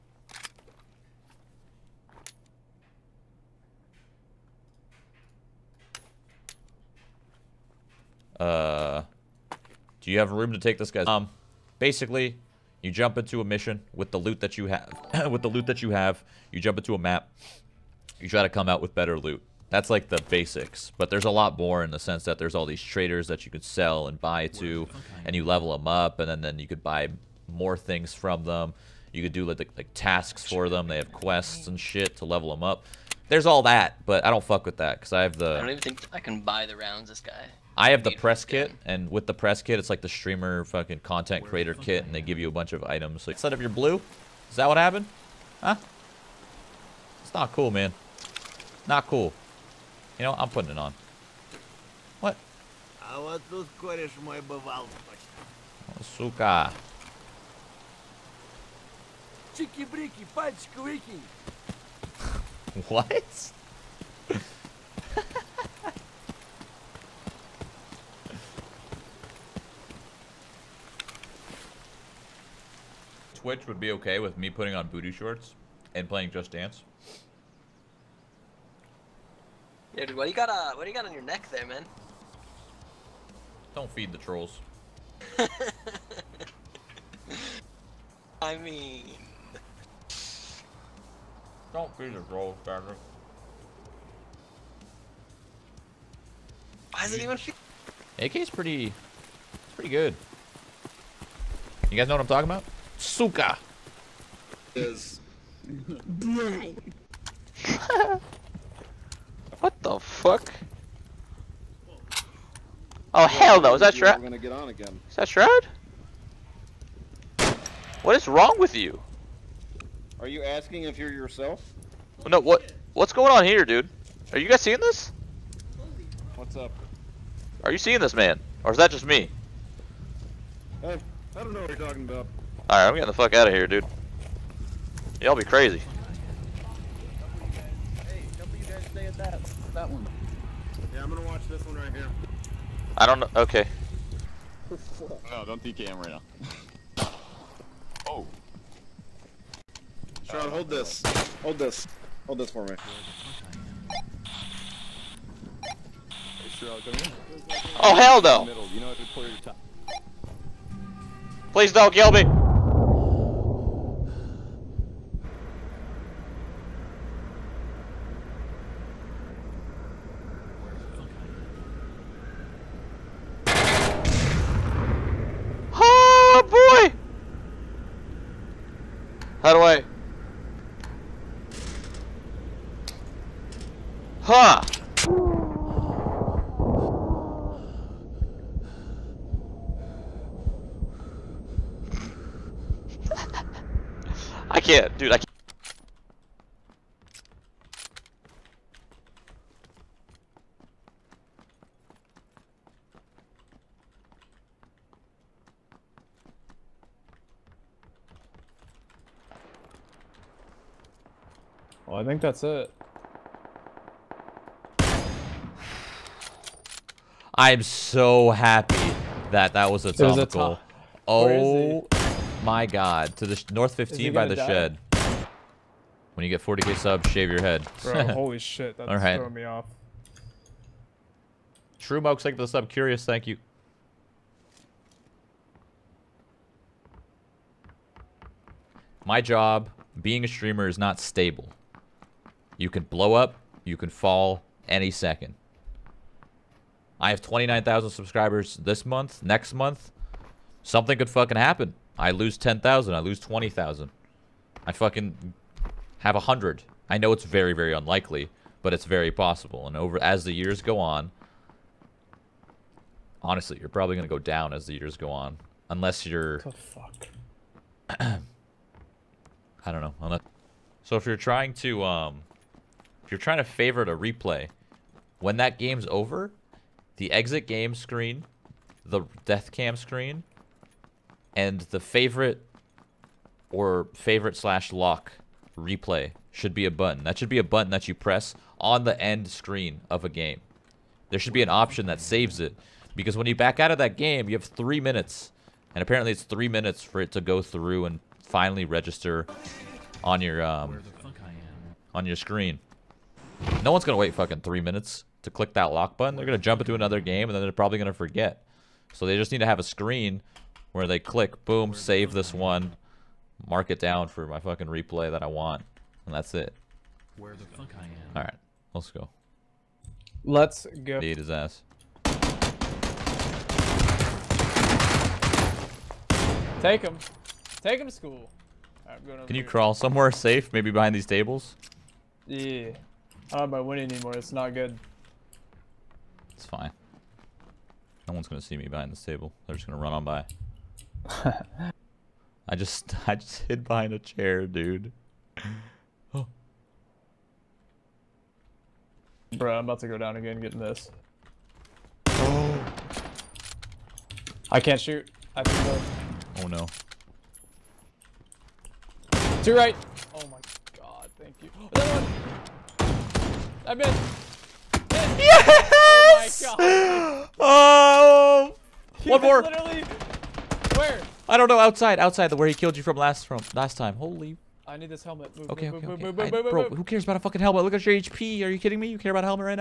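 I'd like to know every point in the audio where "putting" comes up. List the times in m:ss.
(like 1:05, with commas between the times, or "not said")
0:50, 1:14.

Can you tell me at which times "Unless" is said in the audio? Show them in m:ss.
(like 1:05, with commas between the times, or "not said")
4:25, 4:30.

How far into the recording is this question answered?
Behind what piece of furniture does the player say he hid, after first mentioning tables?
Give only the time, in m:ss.
5:43.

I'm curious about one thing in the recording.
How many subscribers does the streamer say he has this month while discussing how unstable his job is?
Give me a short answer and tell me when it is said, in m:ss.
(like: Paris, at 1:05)
29,000, at 4:07.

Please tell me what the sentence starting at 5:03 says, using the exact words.
No one's going to wait fucking three minutes to click that lock button.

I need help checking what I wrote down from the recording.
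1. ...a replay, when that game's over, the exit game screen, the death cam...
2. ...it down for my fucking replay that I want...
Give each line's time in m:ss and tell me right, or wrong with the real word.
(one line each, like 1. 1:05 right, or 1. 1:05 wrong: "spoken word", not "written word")
1. 4:33 right
2. 5:13 right.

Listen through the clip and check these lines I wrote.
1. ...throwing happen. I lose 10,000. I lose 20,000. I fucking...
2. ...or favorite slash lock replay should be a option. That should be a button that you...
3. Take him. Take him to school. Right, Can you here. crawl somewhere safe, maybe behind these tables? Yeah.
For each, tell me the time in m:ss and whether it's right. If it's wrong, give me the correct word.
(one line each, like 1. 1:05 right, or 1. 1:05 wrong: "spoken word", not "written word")
1. 4:11 wrong: "fucking", not "throwing"
2. 4:43 wrong: "button", not "option"
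3. 5:26 right.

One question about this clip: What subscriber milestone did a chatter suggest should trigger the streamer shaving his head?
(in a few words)
40k.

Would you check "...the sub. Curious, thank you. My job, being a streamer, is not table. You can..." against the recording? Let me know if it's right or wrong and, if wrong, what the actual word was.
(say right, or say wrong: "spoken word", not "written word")
wrong: "stable", not "table".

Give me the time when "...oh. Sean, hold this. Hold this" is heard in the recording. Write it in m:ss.
2:28.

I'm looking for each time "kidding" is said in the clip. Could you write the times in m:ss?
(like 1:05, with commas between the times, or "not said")
6:18.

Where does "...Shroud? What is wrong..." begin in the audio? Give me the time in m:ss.
1:55.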